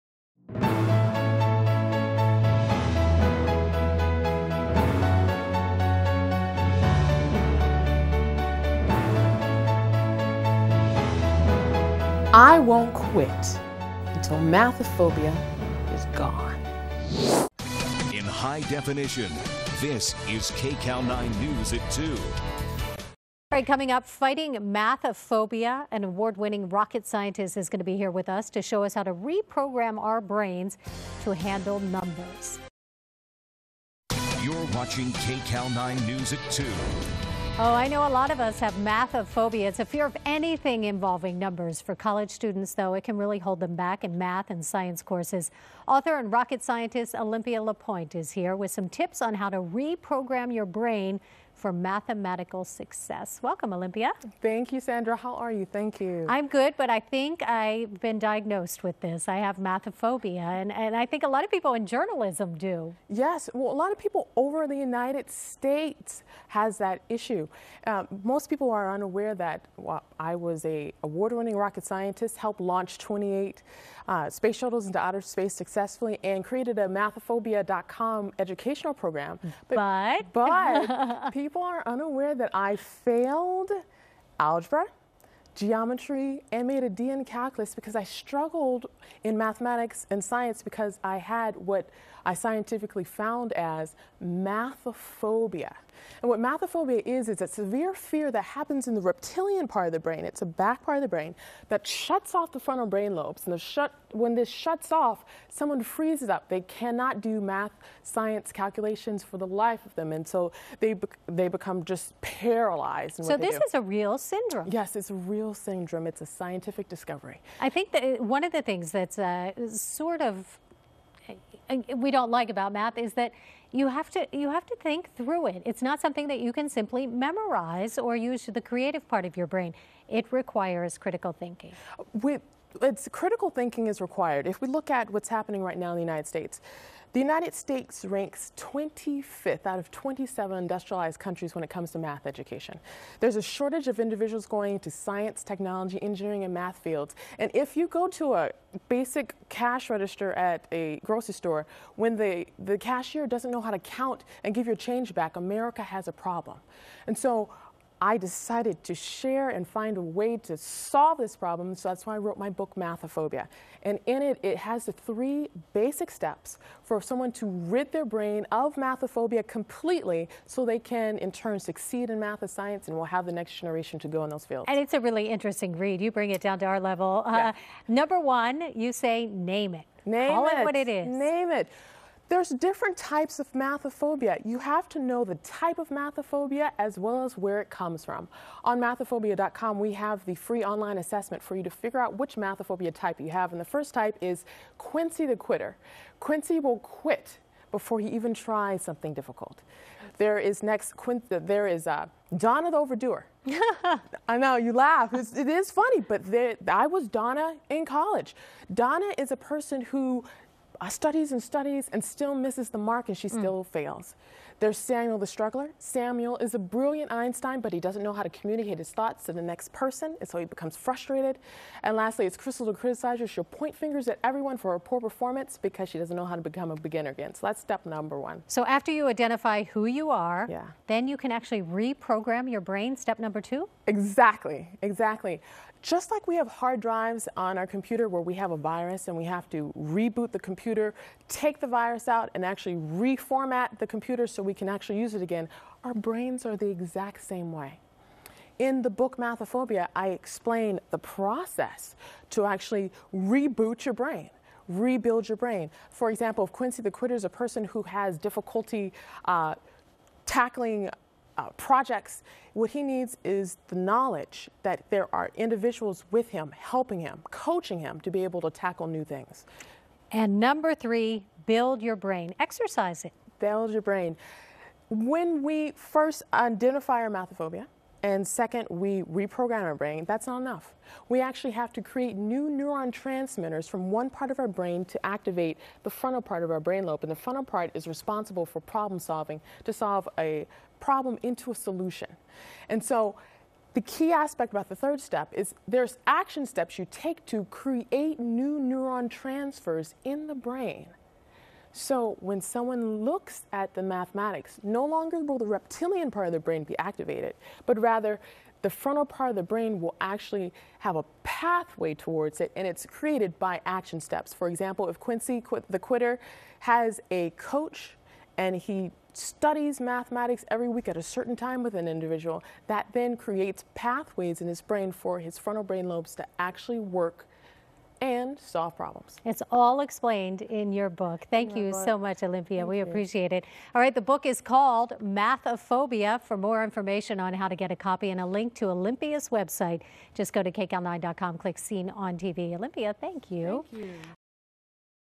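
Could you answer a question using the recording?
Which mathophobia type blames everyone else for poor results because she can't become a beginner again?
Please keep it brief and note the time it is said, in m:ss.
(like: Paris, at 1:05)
Crystal the criticizer, at 3:42.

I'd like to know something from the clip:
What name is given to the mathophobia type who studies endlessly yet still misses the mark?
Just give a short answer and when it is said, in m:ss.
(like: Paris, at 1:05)
Donna the overdoer, at 3:22.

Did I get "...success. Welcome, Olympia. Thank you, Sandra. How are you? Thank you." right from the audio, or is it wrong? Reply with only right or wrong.
right.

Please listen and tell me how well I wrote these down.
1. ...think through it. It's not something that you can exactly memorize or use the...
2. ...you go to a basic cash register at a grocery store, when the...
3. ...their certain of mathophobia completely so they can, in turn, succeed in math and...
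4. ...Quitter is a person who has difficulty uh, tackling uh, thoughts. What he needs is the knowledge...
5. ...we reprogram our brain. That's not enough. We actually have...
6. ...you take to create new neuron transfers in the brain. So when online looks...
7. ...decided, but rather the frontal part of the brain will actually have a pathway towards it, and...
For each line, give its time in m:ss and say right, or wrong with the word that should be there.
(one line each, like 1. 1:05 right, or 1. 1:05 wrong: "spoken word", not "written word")
1. 2:04 wrong: "simply", not "exactly"
2. 2:27 right
3. 2:47 wrong: "brain", not "certain"
4. 4:16 wrong: "projects", not "thoughts"
5. 4:38 right
6. 4:56 wrong: "someone", not "online"
7. 5:06 wrong: "activated", not "decided".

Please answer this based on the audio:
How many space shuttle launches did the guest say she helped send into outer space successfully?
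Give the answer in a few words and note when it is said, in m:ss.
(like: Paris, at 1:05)
28, at 1:12.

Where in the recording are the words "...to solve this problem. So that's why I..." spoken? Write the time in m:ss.
2:40.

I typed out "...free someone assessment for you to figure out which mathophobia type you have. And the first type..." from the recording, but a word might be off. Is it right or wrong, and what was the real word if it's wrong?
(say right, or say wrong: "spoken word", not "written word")
wrong: "online", not "someone".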